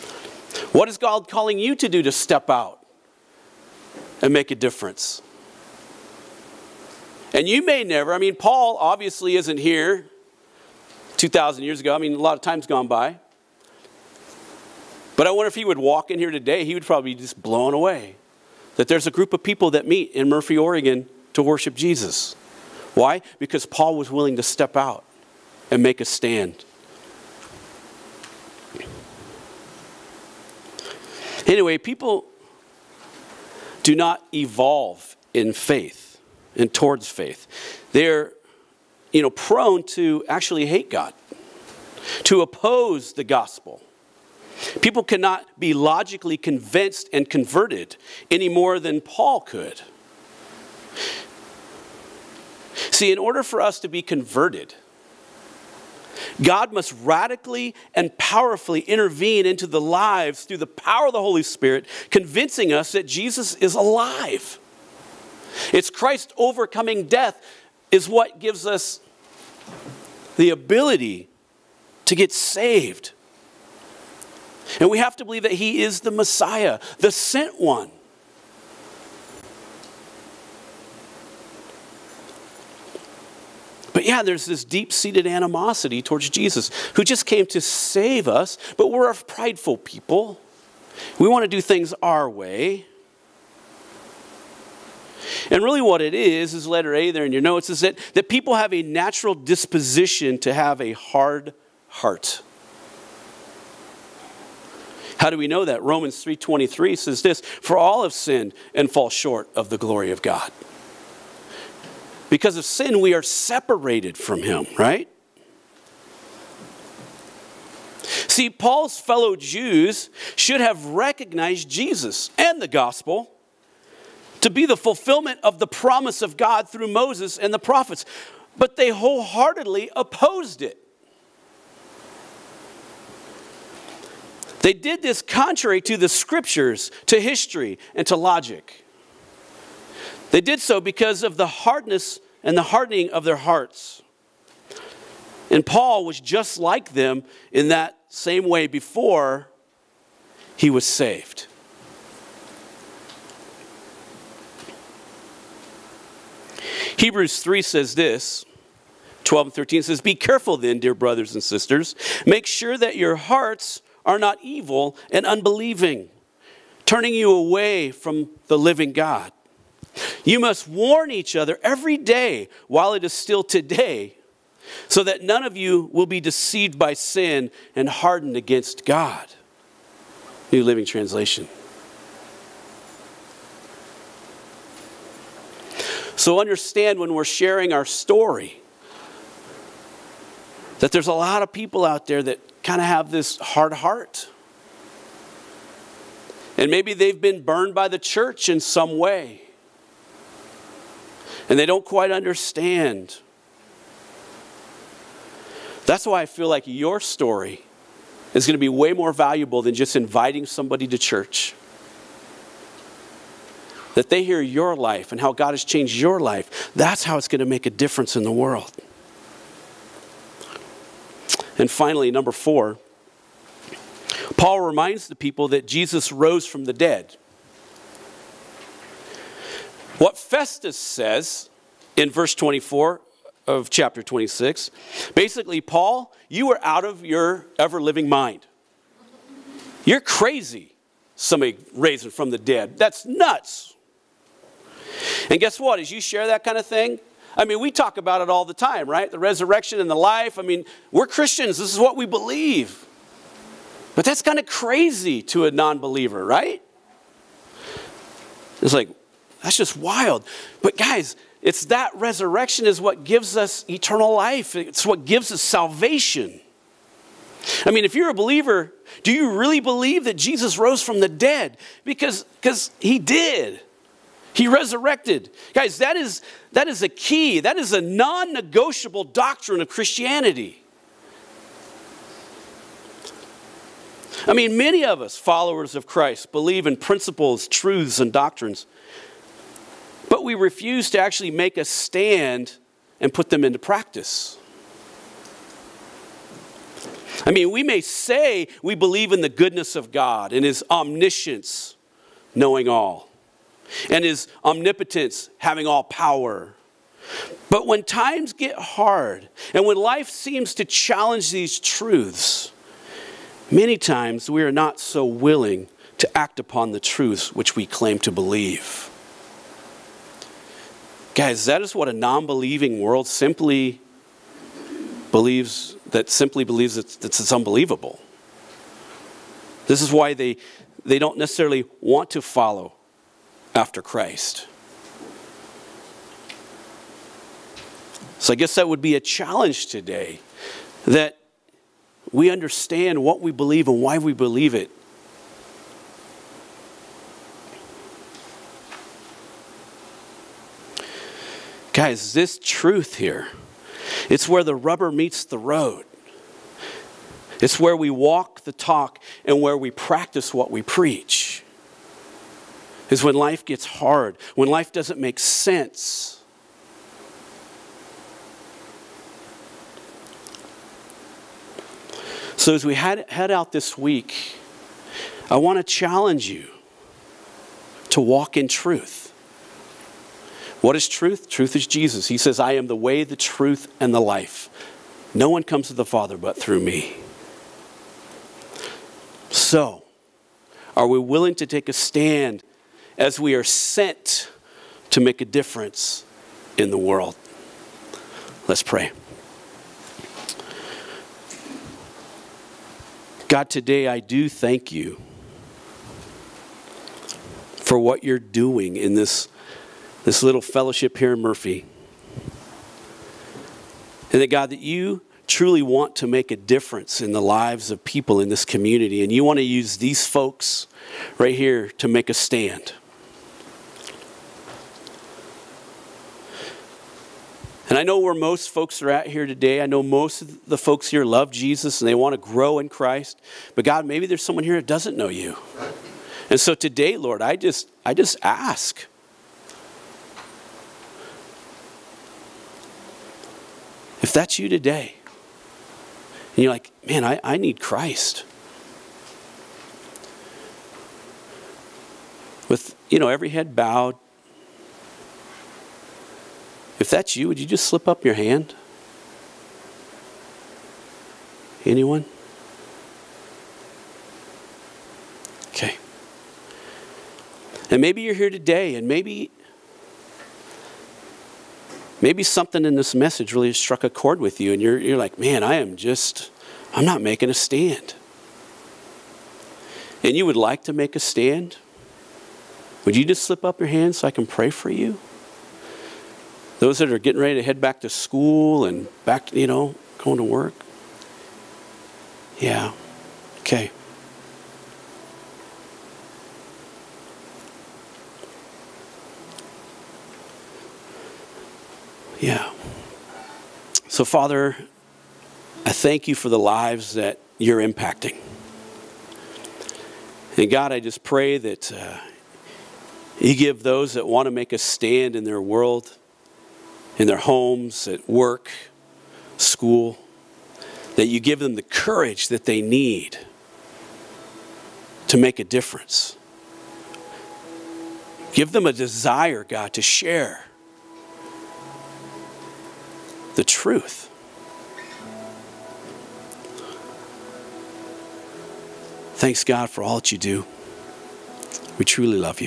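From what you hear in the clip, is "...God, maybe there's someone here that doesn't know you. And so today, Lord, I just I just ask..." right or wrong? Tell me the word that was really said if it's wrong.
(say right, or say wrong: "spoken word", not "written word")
right.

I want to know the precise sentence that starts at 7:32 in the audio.
With, you know, every head bowed.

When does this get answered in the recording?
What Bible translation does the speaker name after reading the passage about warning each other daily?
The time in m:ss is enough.
3:00.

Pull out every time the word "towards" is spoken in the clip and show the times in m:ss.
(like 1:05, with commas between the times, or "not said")
0:36, 1:25.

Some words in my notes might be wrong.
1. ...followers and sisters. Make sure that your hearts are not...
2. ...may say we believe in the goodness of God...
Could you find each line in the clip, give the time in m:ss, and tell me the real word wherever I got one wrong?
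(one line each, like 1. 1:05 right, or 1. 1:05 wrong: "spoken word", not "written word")
1. 2:40 wrong: "brothers", not "followers"
2. 4:57 right.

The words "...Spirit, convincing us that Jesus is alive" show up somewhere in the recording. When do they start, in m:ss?
1:01.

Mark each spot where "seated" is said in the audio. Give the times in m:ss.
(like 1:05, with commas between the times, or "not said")
1:24.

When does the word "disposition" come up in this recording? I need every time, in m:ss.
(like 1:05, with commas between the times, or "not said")
1:39.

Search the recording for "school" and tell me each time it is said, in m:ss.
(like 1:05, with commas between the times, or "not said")
8:07, 8:39.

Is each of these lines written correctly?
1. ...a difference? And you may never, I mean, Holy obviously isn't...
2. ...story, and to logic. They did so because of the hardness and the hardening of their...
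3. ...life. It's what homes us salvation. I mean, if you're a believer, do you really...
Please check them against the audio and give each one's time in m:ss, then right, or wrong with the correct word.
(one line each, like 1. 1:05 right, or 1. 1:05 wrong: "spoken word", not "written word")
1. 0:04 wrong: "Paul", not "Holy"
2. 2:17 wrong: "history", not "story"
3. 4:24 wrong: "gives", not "homes".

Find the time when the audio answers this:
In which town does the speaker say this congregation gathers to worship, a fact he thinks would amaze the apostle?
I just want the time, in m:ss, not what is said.
0:20.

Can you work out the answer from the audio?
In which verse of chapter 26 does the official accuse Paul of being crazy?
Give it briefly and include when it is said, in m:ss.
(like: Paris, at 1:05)
Verse 24, at 3:52.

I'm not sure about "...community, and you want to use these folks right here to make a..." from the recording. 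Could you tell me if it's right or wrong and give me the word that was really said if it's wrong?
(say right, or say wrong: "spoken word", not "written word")
right.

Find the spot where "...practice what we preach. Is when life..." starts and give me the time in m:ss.
5:59.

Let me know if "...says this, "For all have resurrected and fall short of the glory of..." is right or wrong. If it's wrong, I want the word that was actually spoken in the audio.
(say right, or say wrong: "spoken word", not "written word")
wrong: "sinned", not "resurrected".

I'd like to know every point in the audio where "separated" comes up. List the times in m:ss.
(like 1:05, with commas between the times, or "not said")
1:53.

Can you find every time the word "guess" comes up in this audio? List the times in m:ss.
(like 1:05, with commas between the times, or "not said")
4:05, 5:38.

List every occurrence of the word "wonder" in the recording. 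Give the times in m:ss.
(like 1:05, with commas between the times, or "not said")
0:15.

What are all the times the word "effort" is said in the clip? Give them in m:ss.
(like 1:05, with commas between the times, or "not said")
not said.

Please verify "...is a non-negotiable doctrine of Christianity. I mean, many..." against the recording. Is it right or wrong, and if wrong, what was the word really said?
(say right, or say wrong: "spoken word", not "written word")
right.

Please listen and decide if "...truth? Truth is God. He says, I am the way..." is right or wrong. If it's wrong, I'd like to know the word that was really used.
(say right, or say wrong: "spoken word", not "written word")
wrong: "Jesus", not "God".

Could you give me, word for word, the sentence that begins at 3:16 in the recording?
And maybe they've been burned by the church in some way and they don't quite understand.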